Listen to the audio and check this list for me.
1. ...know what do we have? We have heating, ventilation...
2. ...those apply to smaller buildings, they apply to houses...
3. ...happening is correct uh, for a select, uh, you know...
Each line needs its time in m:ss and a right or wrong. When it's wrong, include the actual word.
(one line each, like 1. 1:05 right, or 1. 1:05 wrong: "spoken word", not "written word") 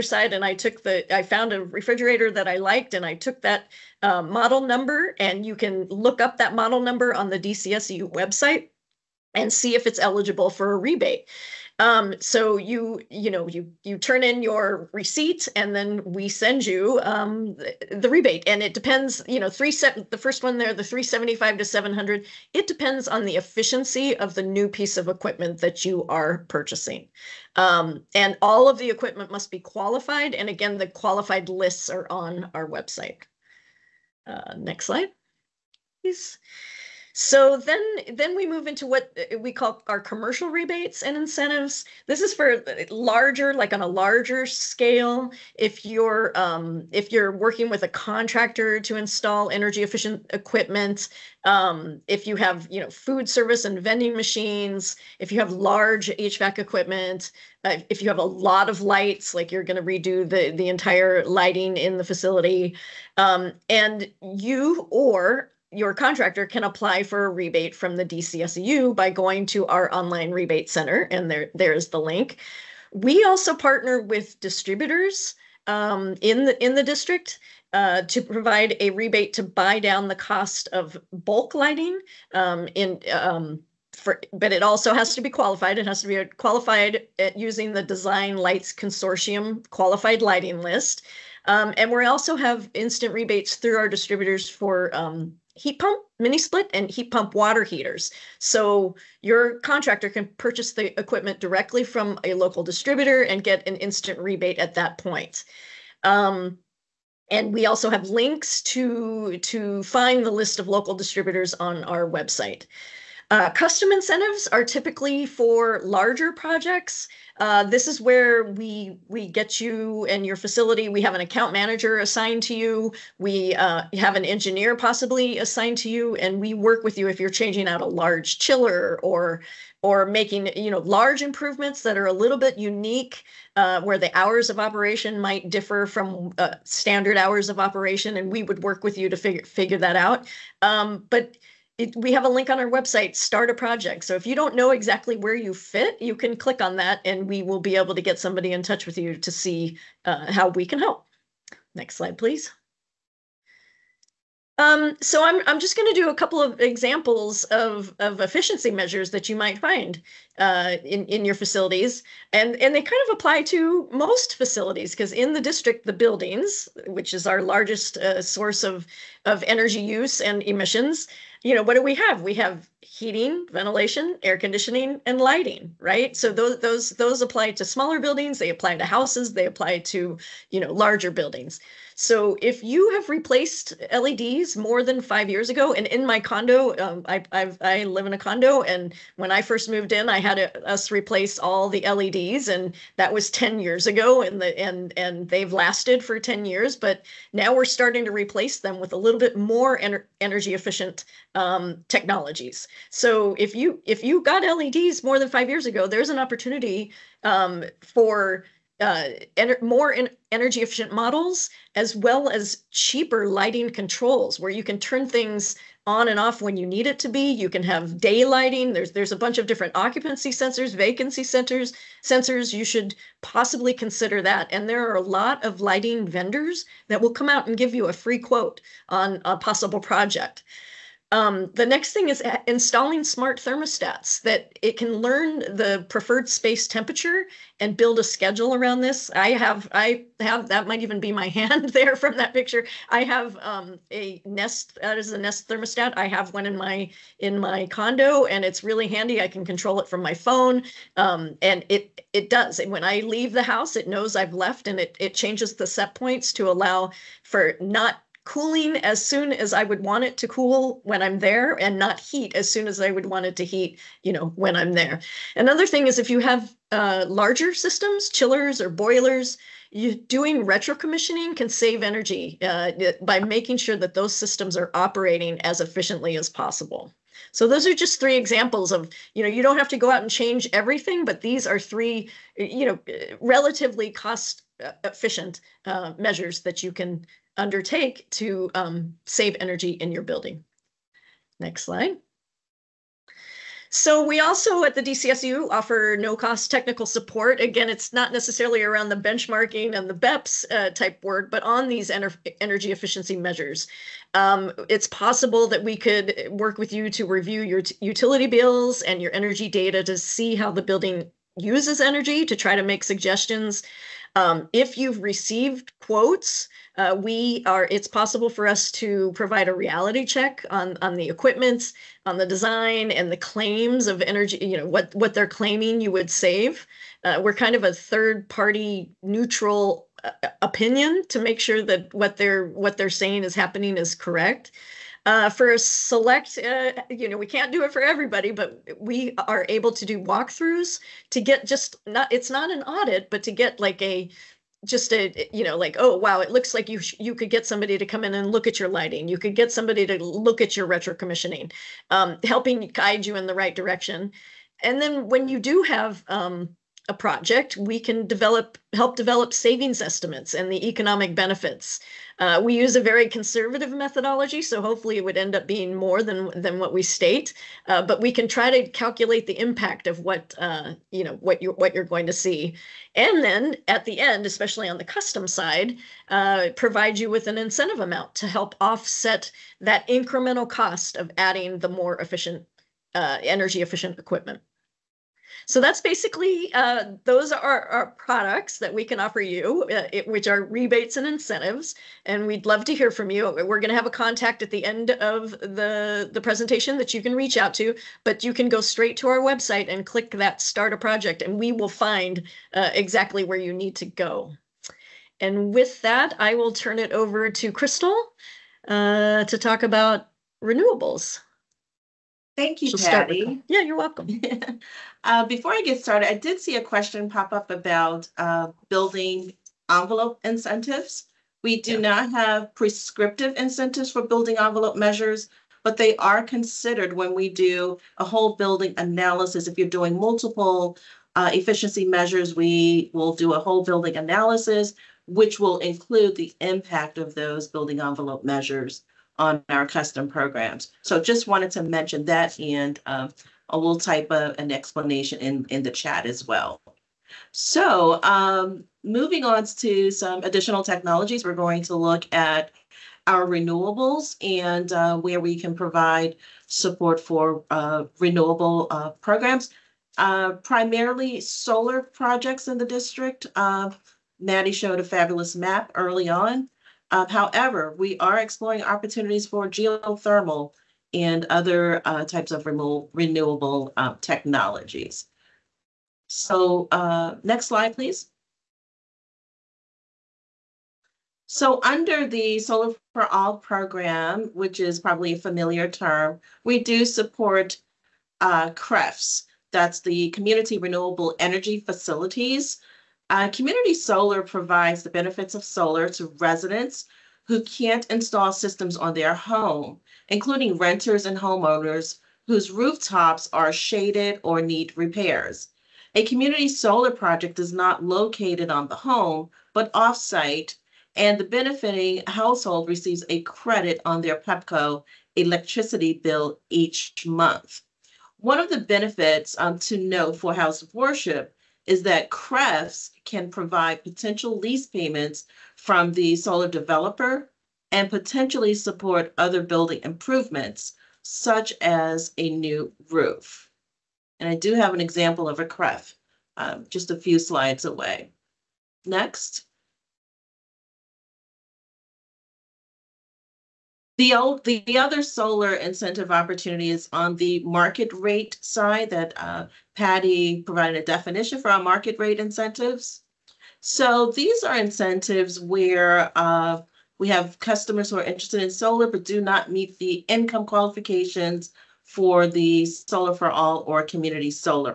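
1. 2:51 right
2. 2:57 right
3. 5:33 right.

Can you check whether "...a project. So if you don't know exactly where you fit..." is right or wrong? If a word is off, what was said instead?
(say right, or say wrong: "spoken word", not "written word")
right.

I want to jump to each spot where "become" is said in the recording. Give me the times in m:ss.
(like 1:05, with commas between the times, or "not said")
not said.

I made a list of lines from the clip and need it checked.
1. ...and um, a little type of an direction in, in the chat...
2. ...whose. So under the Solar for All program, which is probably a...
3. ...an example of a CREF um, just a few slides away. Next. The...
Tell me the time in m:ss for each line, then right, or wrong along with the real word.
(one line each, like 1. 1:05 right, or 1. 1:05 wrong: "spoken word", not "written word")
1. 7:22 wrong: "explanation", not "direction"
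2. 7:57 wrong: "please", not "whose"
3. 8:54 right.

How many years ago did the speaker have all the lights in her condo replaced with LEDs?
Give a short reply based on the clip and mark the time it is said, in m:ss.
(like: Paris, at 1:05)
10 years, at 3:13.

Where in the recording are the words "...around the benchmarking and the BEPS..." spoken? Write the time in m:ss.
4:58.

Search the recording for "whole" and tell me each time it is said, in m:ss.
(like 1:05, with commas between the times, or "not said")
7:08, 7:13.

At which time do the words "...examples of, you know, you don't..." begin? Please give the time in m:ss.
4:38.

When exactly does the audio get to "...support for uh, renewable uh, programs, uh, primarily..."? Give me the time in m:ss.
7:36.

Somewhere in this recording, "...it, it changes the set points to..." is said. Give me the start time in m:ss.
4:14.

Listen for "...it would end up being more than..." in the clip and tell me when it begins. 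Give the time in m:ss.
6:04.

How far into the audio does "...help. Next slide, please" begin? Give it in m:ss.
2:30.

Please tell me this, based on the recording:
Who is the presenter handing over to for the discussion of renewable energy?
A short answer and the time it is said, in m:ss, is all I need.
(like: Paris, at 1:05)
Crystal, at 6:47.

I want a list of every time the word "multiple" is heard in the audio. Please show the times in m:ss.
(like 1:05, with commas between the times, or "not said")
7:09.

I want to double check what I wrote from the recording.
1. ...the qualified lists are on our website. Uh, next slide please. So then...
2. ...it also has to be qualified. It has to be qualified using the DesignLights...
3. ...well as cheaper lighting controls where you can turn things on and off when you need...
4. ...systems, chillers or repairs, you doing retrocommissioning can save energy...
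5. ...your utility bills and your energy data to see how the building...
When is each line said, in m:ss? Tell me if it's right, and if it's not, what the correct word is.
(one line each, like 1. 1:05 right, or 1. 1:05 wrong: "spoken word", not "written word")
1. 0:30 right
2. 1:24 right
3. 3:31 right
4. 4:27 wrong: "boilers", not "repairs"
5. 5:07 right.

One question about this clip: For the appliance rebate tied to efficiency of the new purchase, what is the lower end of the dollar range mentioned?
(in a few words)
$375.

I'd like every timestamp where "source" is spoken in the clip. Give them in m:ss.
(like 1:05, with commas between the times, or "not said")
2:48.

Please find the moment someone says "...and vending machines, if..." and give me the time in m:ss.
0:53.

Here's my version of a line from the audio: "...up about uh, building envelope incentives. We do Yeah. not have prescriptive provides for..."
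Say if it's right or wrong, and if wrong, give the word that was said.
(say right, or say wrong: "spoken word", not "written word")
wrong: "incentives", not "provides".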